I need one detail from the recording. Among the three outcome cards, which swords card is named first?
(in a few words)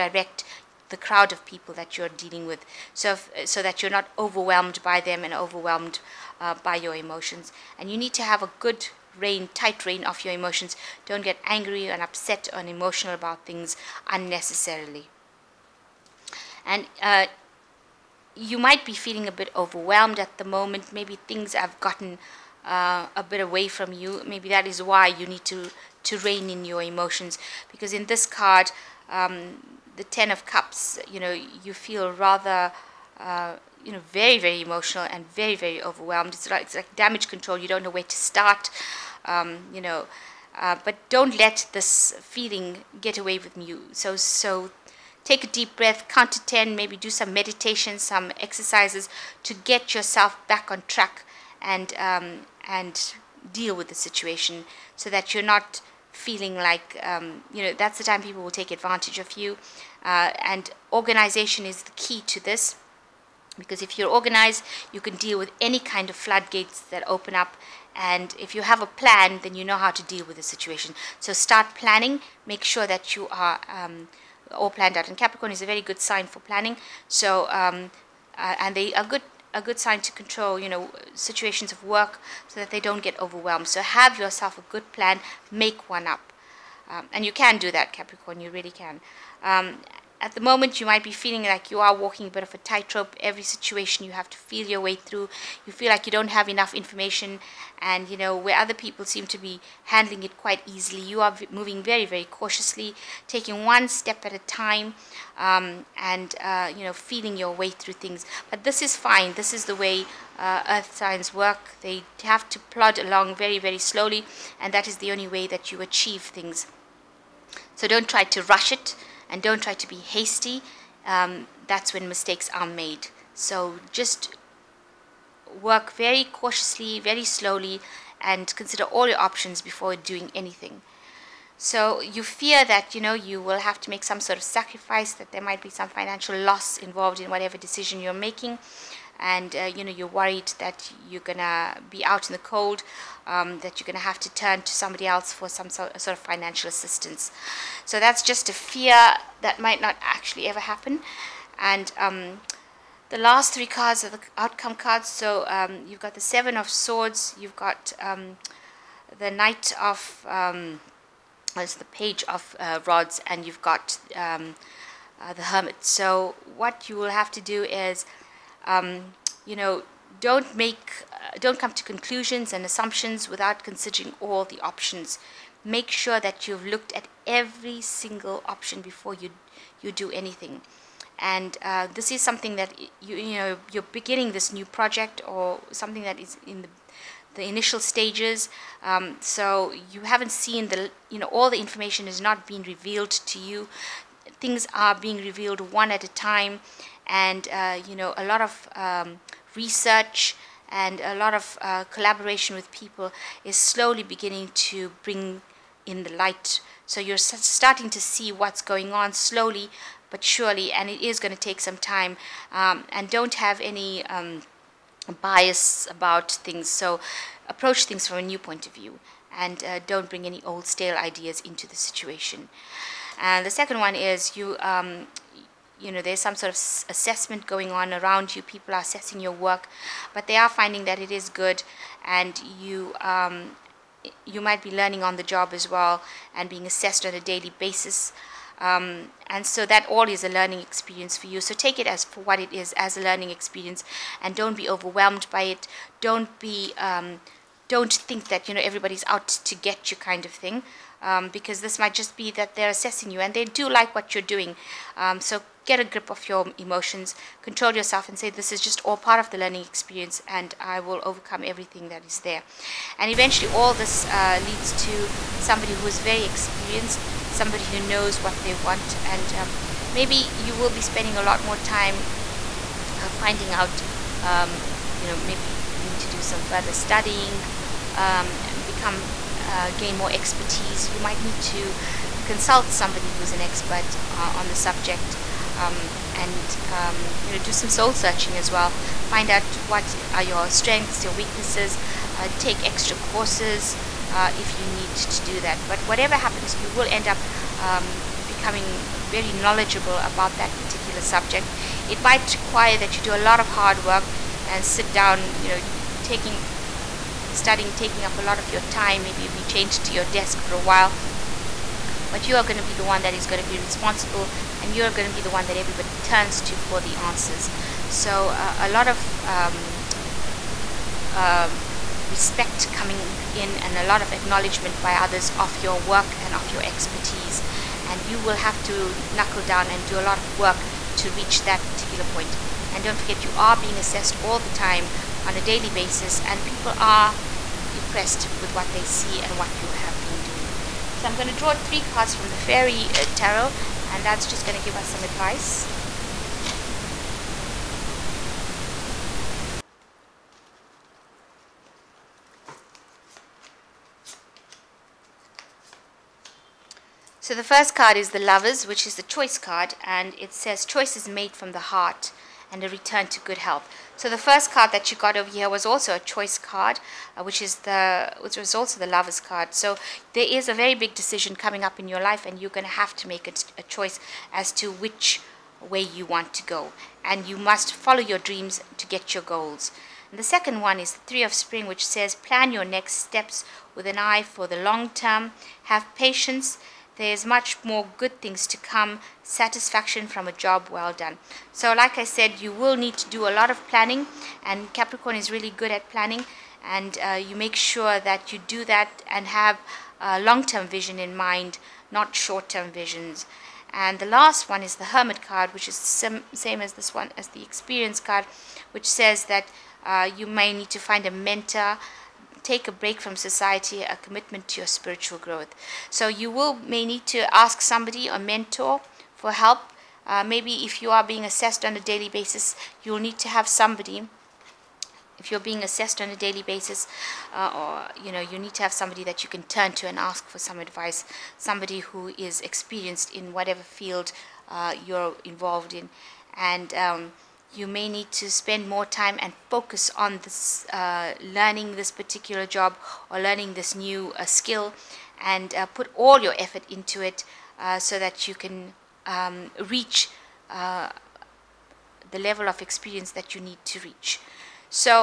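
Seven of Swords.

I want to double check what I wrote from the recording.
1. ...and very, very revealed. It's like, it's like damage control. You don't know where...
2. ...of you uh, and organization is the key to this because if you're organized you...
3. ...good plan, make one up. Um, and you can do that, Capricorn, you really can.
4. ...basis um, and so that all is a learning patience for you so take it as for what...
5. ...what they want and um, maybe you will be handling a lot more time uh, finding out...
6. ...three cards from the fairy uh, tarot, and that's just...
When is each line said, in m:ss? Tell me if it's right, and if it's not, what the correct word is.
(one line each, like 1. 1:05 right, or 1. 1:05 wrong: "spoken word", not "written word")
1. 0:35 wrong: "overwhelmed", not "revealed"
2. 0:59 right
3. 1:24 right
4. 3:57 wrong: "experience", not "patience"
5. 4:28 wrong: "spending", not "handling"
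6. 5:41 right.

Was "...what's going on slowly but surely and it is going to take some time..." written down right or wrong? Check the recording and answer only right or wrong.
right.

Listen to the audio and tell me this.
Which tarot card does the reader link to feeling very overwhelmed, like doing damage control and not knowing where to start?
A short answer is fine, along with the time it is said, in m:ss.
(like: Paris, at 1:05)
Ten of Cups, at 0:30.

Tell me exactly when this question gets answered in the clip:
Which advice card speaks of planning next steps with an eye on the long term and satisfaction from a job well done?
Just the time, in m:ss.
6:21.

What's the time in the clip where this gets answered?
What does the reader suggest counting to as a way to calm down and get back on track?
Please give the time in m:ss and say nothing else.
0:46.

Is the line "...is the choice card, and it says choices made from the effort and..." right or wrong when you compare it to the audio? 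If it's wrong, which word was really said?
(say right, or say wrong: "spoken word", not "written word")
wrong: "heart", not "effort".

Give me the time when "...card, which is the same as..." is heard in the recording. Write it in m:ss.
6:45.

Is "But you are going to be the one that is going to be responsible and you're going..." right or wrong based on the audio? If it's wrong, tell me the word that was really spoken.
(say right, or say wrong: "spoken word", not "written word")
right.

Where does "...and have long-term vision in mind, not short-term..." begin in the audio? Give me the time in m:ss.
6:39.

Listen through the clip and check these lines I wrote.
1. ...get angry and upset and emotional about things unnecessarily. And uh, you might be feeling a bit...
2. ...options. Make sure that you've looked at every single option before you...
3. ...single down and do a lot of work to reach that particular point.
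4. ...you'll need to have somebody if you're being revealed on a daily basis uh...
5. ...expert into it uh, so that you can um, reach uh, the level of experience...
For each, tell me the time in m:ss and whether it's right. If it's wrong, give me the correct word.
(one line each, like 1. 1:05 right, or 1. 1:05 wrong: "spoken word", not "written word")
1. 0:11 right
2. 2:54 right
3. 5:29 wrong: "knuckle", not "single"
4. 7:02 wrong: "assessed", not "revealed"
5. 7:26 wrong: "effort", not "expert".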